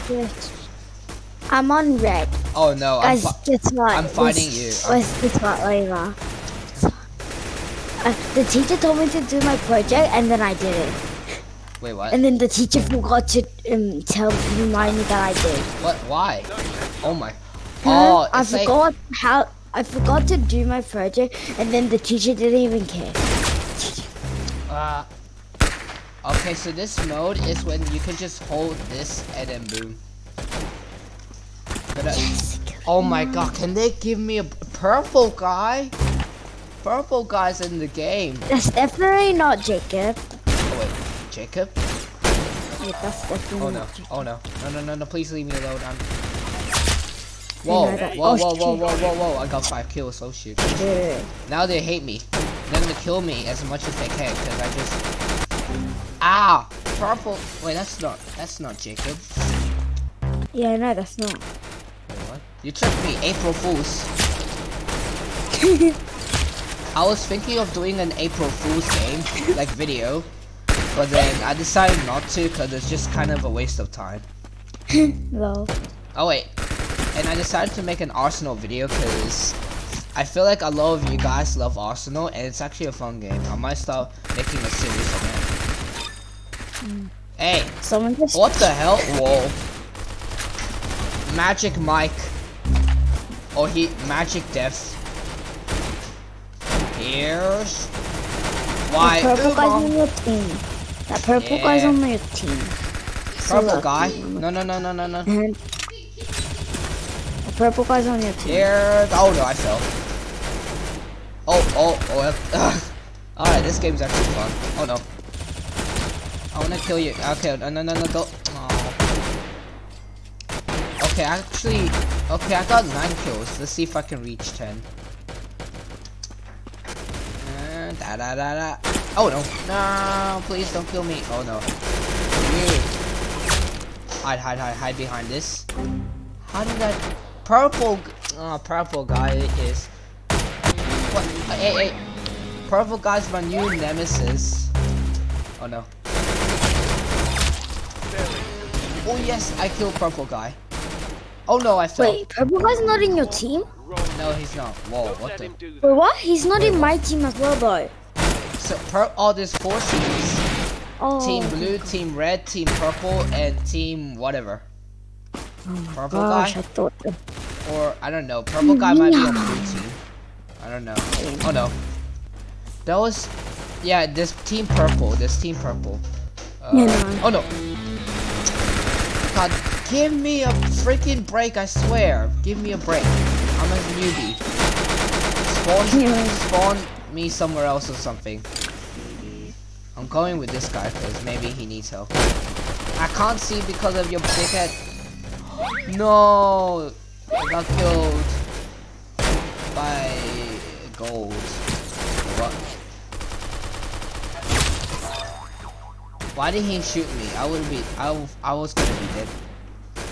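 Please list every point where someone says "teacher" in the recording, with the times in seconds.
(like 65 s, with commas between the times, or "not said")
8 s, 12 s, 21 s.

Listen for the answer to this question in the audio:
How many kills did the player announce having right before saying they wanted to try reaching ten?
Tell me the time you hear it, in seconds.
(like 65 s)
122 s.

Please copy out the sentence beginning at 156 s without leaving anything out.
He's not in my team as well, though.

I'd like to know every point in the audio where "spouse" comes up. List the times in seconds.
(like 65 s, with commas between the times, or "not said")
not said.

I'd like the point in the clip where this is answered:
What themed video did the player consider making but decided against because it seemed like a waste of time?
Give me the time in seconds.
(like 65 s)
68 s.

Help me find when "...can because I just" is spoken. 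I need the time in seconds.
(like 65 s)
54 s.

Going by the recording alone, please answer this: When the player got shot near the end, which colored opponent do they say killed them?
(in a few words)
gold.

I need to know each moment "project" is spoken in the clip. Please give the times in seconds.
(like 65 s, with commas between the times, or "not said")
9 s, 20 s.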